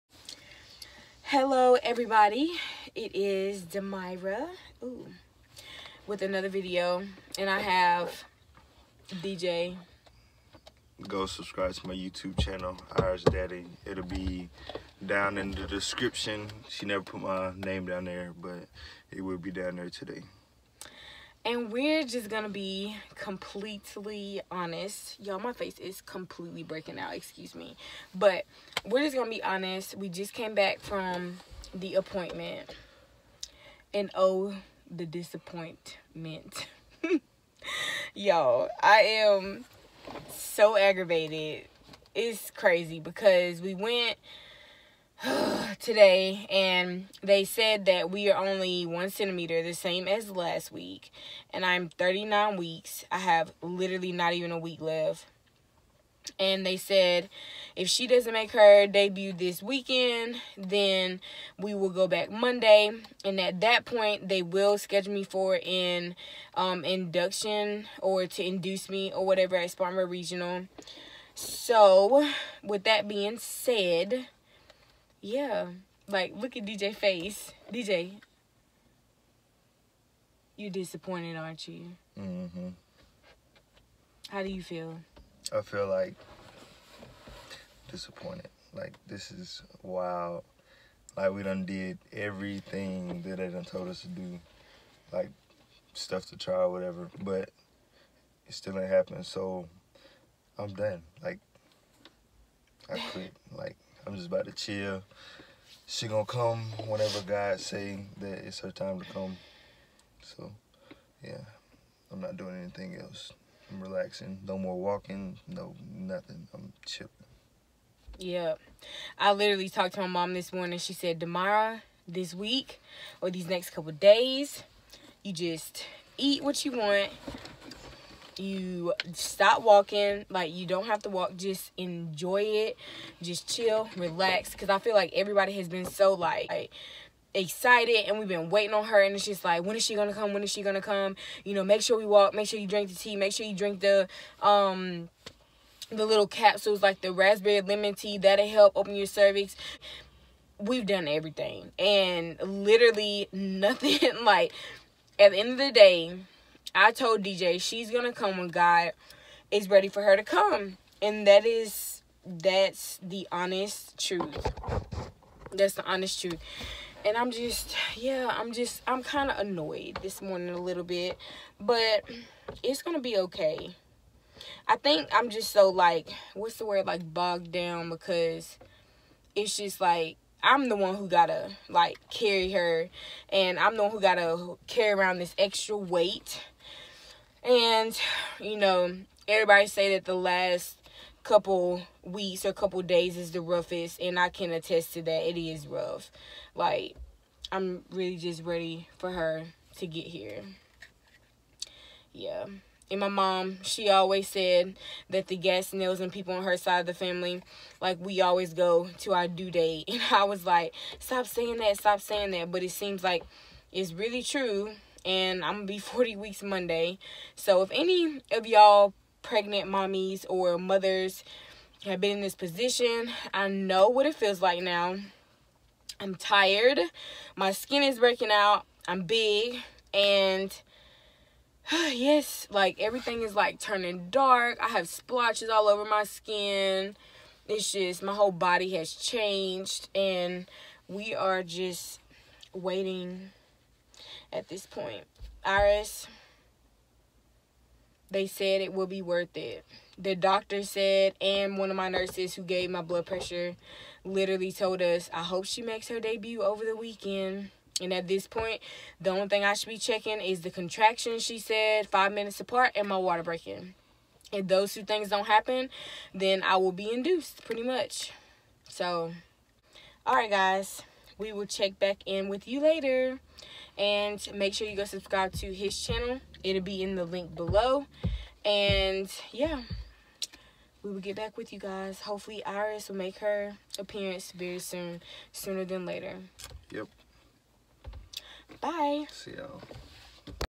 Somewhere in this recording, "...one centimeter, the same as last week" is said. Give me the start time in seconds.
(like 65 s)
48 s.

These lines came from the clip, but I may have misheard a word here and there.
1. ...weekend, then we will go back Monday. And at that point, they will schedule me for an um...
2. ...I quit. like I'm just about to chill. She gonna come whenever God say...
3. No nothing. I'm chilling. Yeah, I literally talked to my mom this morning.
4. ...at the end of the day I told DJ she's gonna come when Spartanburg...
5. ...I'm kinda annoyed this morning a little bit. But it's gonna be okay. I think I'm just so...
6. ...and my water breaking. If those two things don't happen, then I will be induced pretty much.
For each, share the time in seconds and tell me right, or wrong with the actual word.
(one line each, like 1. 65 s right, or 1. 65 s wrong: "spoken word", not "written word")
1. 59 s right
2. 102 s right
3. 115 s right
4. 155 s wrong: "God", not "Spartanburg"
5. 168 s right
6. 262 s right.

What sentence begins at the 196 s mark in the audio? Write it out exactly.
Like I'm really just ready for her to get here.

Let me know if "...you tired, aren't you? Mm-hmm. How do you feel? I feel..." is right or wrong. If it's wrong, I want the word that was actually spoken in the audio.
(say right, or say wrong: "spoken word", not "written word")
wrong: "disappointed", not "tired".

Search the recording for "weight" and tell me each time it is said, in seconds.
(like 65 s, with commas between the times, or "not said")
185 s.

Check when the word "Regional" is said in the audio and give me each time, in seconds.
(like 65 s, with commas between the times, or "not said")
70 s.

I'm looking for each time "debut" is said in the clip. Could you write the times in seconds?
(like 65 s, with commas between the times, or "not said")
58 s, 255 s.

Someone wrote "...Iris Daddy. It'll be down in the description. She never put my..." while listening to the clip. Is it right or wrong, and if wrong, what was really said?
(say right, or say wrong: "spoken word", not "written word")
right.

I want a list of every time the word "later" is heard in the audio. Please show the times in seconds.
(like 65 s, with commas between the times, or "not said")
272 s, 285 s.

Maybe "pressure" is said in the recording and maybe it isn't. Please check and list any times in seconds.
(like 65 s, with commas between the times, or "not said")
253 s.